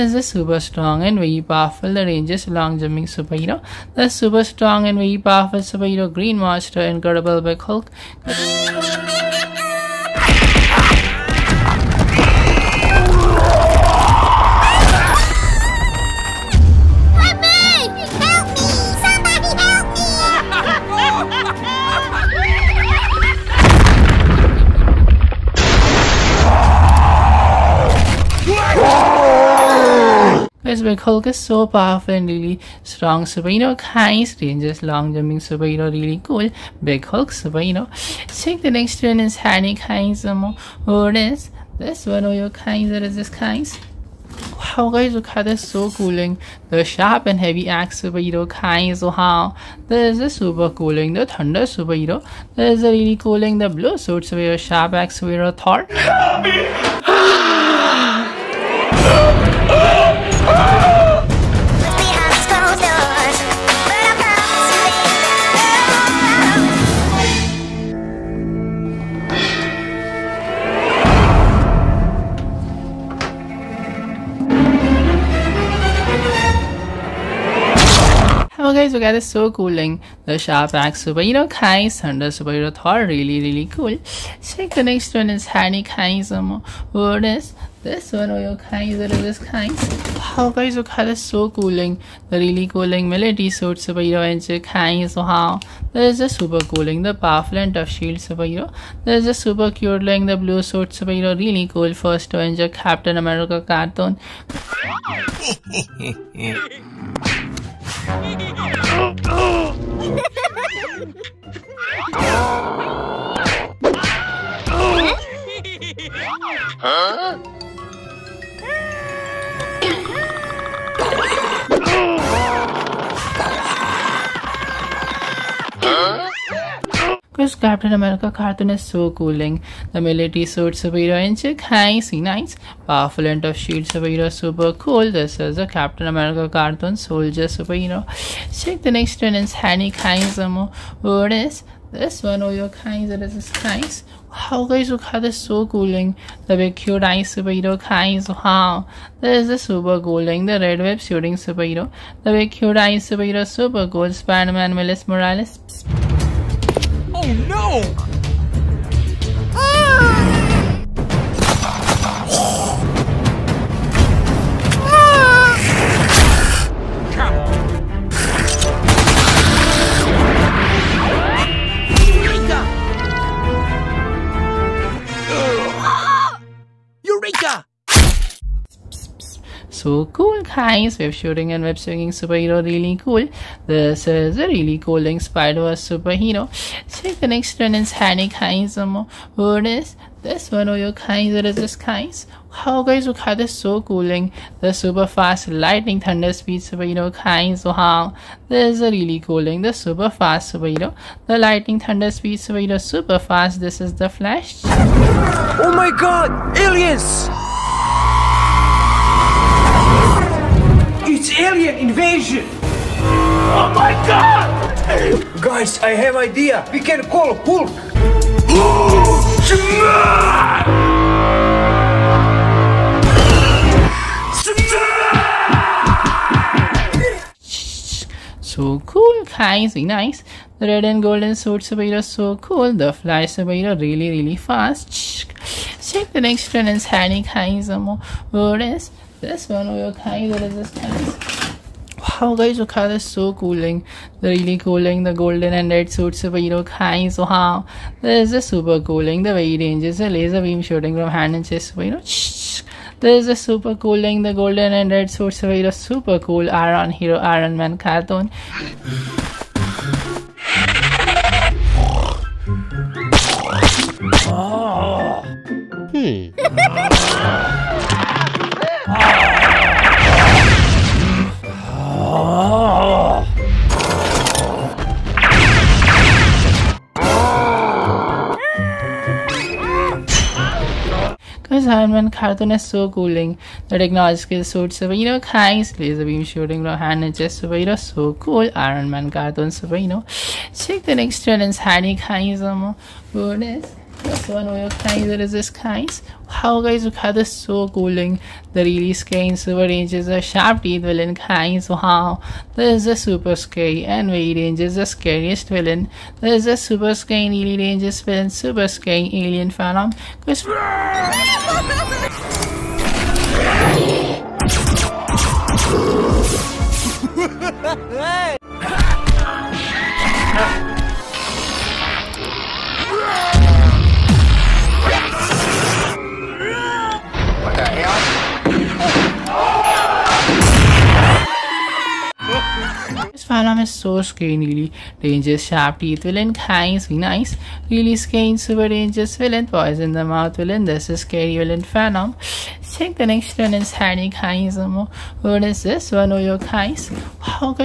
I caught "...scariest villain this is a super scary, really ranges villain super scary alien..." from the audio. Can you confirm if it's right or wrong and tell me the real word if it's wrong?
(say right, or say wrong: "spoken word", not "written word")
right.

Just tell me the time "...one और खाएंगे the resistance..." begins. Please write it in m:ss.
3:59.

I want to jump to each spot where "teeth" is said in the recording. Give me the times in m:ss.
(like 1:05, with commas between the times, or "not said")
5:00, 5:35.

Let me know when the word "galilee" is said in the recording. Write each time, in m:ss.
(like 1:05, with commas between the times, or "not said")
not said.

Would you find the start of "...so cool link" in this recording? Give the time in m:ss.
1:19.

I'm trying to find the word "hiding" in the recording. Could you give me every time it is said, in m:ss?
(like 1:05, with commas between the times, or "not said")
5:43.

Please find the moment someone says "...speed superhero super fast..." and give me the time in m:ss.
3:22.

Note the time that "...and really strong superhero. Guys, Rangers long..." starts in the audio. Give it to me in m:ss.
0:32.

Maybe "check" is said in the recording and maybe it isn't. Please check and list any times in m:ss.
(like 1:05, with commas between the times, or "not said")
0:38, 1:24, 2:18, 3:07, 3:55, 4:50, 5:42.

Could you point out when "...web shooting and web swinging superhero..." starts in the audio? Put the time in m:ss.
3:00.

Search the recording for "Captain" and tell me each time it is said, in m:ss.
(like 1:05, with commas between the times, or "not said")
1:42, 2:07, 2:15.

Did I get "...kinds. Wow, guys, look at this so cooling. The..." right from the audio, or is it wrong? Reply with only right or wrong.
right.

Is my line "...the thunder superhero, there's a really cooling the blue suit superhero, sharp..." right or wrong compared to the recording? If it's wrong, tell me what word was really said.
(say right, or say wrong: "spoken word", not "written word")
right.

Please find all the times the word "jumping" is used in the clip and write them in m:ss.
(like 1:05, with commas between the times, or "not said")
0:02, 0:35.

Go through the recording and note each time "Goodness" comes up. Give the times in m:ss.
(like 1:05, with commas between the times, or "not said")
4:53.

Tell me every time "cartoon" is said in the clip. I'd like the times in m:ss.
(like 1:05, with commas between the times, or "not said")
1:43, 2:08, 2:16, 4:17, 4:42, 4:49.